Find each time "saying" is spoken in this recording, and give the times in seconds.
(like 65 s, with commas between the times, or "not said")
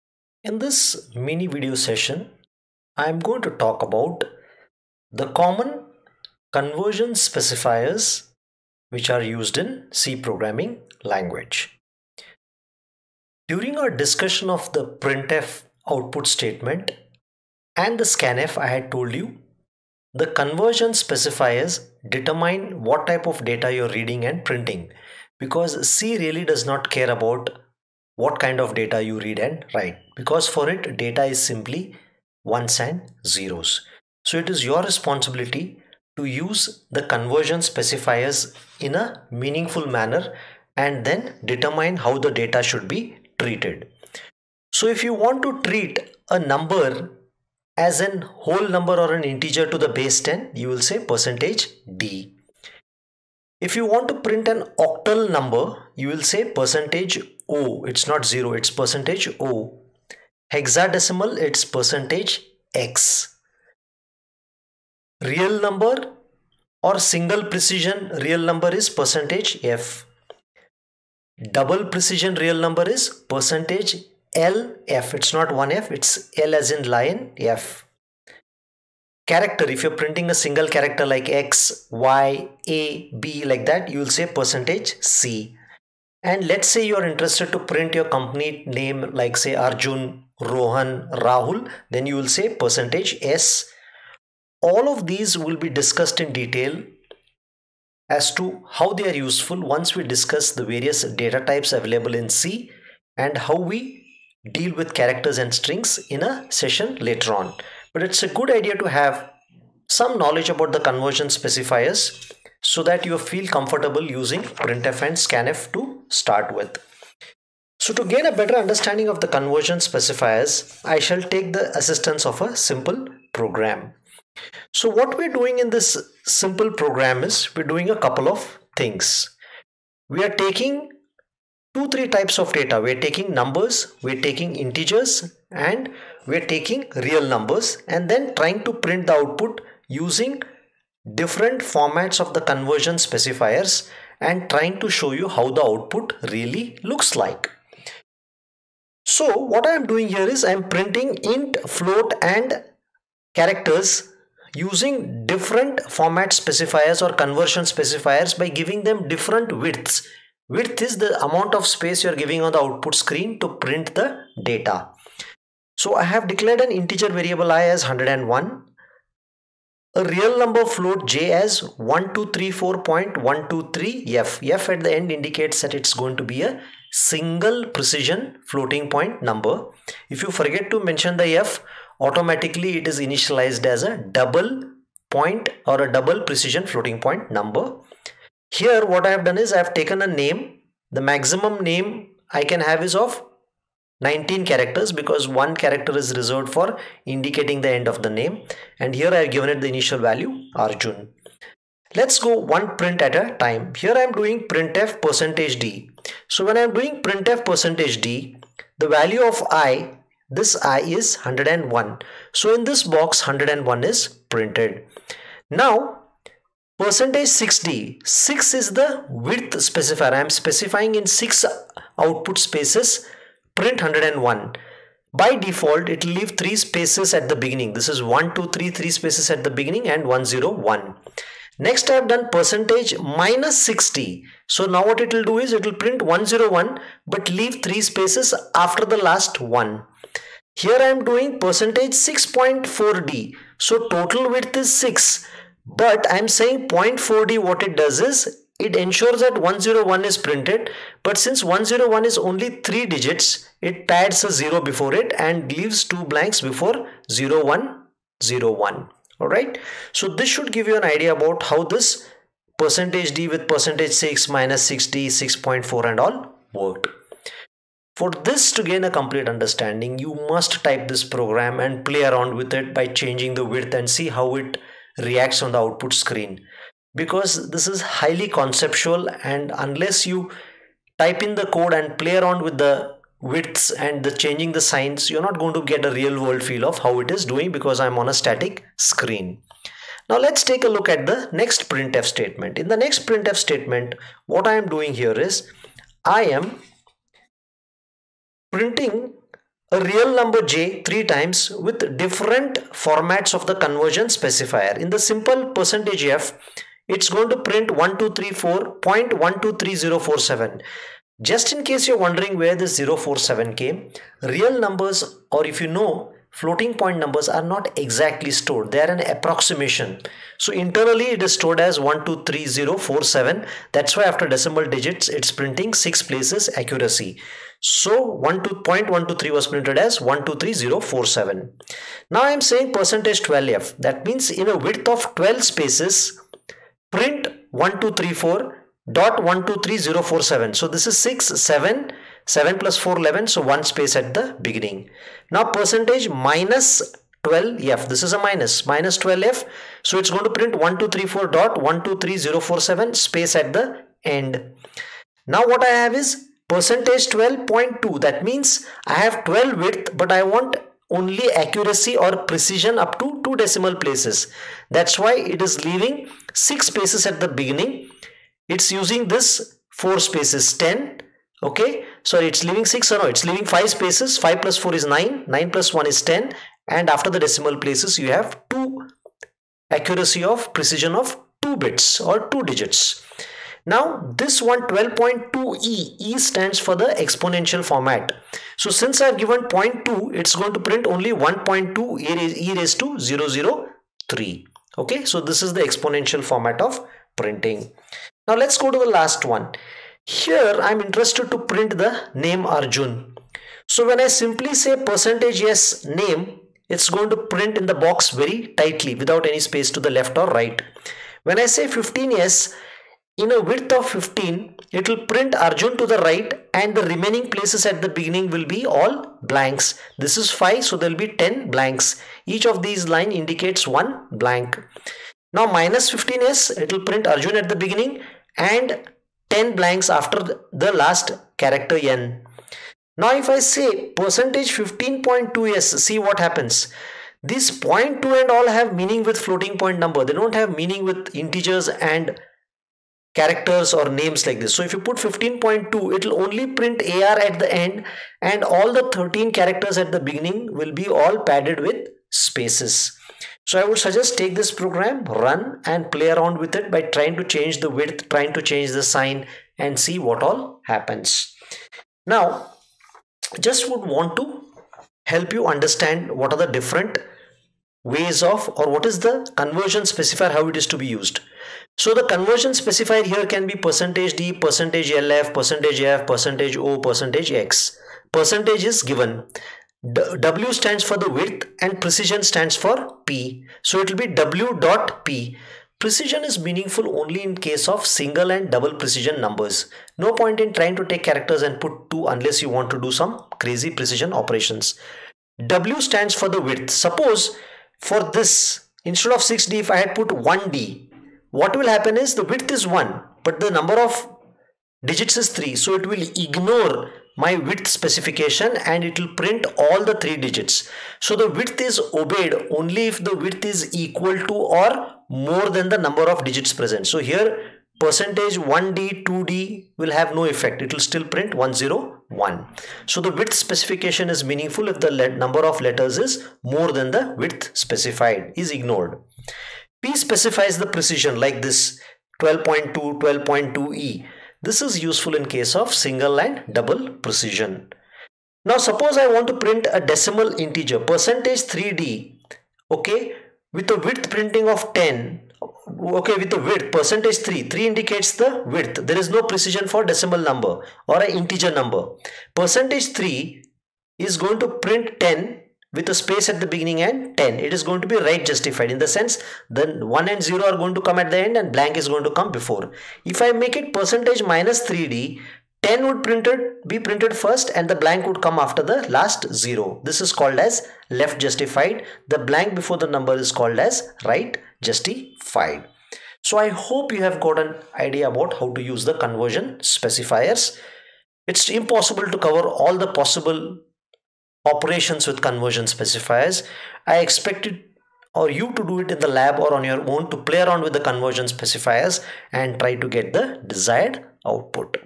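246 s, 332 s.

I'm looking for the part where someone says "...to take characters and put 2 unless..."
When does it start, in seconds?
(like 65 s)
490 s.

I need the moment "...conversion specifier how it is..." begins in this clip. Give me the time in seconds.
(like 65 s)
469 s.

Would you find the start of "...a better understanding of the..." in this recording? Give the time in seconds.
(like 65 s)
118 s.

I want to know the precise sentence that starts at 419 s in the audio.
This is 5 so there will be 10 blanks.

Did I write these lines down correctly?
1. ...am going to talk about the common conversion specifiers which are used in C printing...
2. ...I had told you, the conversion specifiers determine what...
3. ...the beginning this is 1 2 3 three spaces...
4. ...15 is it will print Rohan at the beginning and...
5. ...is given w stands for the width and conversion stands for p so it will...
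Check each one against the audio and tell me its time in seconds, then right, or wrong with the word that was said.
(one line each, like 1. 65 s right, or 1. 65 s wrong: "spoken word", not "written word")
1. 3 s wrong: "programming", not "printing"
2. 18 s right
3. 227 s right
4. 425 s wrong: "Arjun", not "Rohan"
5. 478 s wrong: "precision", not "conversion".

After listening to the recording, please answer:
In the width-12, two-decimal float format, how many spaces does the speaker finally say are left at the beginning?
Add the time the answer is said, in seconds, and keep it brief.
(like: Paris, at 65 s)
5, at 373 s.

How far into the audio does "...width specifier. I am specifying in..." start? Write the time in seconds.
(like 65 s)
219 s.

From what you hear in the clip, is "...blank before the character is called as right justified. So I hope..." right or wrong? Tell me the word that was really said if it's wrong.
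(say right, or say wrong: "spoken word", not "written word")
wrong: "number", not "character".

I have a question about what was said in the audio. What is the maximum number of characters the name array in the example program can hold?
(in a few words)
19.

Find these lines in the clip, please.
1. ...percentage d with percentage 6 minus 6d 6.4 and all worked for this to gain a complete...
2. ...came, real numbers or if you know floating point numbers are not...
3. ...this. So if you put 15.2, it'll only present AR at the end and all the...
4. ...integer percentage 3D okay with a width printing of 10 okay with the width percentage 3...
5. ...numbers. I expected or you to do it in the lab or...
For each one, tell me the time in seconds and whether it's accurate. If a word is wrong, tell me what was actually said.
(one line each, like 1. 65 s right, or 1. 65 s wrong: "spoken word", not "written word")
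1. 262 s right
2. 313 s right
3. 444 s wrong: "print", not "present"
4. 540 s right
5. 585 s wrong: "specifiers", not "numbers".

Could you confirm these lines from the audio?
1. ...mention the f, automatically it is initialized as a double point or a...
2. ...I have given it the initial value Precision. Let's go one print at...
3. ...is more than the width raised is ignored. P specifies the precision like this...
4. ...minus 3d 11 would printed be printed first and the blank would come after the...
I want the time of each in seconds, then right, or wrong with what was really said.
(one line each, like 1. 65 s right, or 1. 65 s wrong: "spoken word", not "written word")
1. 180 s right
2. 199 s wrong: "Arjun", not "Precision"
3. 525 s wrong: "specified", not "raised"
4. 564 s wrong: "10", not "11".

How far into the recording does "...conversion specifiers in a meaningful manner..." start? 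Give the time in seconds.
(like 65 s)
37 s.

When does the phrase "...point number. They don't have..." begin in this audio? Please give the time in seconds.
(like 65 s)
439 s.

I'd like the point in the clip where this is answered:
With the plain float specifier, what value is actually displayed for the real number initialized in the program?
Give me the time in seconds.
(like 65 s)
307 s.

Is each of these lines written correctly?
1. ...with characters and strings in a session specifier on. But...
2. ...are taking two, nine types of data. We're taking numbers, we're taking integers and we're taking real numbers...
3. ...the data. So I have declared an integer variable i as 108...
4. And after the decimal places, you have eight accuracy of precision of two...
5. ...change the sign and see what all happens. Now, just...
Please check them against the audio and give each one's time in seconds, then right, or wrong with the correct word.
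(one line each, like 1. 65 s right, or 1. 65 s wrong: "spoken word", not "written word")
1. 104 s wrong: "later", not "specifier"
2. 130 s wrong: "three", not "nine"
3. 163 s wrong: "101", not "108"
4. 376 s wrong: "two", not "eight"
5. 458 s right.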